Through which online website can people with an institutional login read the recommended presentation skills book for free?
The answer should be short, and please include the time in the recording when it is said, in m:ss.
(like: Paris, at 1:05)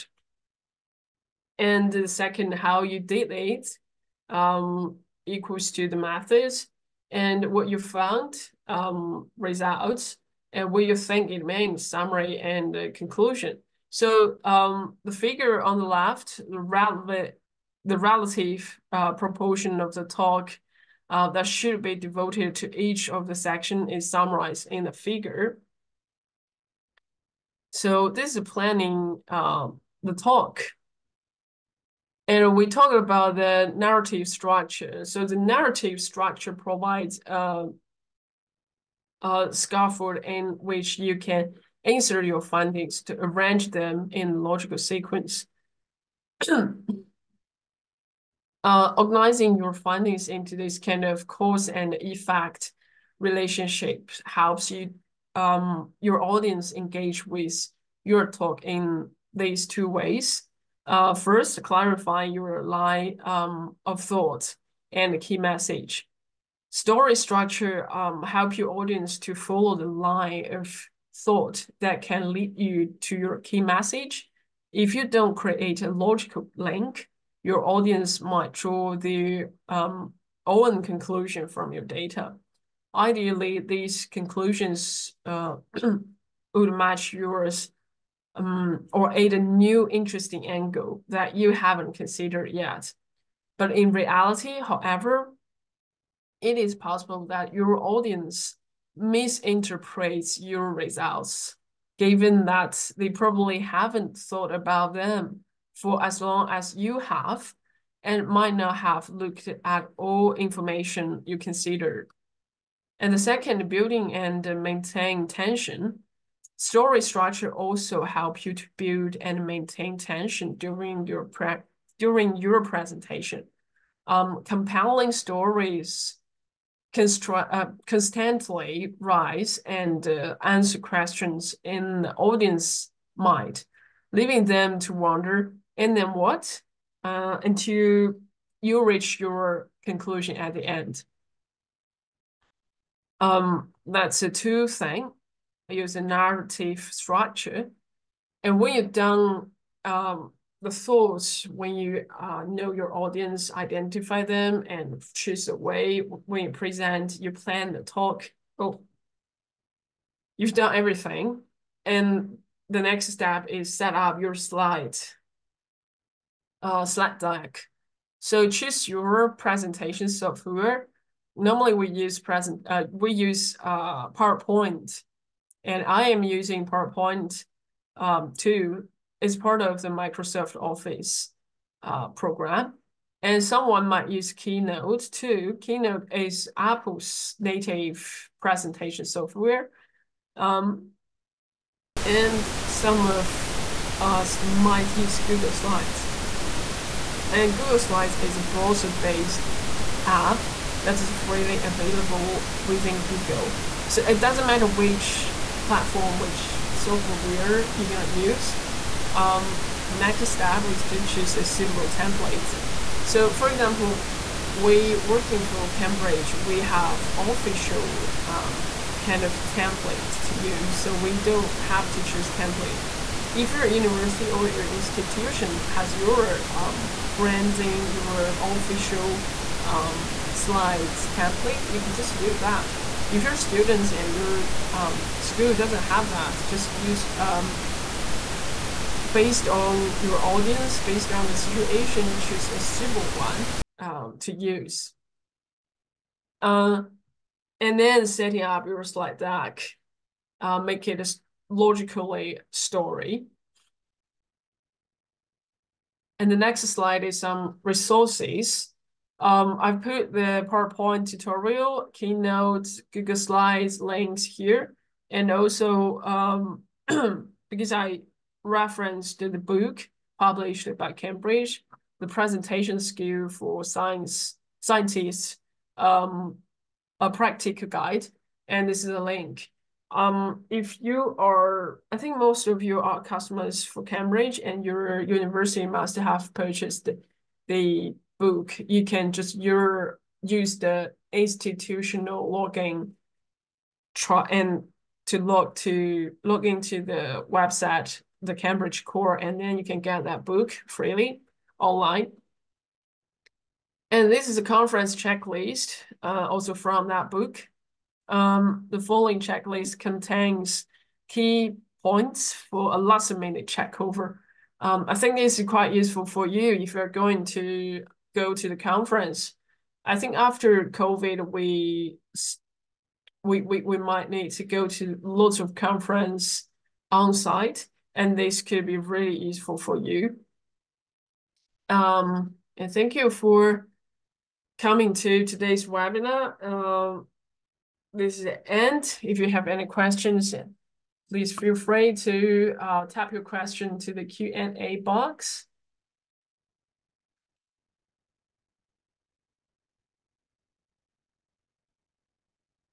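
Cambridge Core, at 4:58.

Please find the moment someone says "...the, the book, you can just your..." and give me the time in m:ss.
4:46.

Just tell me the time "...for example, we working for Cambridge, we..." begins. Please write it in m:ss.
3:33.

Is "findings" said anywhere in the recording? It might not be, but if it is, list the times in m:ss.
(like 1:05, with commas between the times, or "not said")
0:42, 0:49.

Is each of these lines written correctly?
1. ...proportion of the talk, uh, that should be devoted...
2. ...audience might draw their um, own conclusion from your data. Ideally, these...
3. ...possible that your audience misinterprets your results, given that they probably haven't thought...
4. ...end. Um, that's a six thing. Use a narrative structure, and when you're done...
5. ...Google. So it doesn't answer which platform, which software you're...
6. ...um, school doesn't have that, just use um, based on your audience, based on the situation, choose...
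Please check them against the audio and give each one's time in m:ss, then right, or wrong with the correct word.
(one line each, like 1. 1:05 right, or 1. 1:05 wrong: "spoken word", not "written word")
1. 0:19 right
2. 1:17 right
3. 1:36 right
4. 2:20 wrong: "two", not "six"
5. 3:23 wrong: "matter", not "answer"
6. 3:54 right.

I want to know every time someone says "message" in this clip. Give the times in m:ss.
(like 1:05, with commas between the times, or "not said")
1:05, 1:13.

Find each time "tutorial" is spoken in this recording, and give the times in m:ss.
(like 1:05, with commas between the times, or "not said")
4:21.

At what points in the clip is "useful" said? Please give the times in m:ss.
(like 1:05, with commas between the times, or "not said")
5:15, 5:29.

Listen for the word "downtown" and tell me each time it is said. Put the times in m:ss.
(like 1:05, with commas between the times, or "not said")
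not said.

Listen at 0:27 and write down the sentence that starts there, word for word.
So this is planning uh, the talk.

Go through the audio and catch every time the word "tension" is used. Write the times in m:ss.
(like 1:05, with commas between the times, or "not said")
1:55, 1:59.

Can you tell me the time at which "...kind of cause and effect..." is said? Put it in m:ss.
0:50.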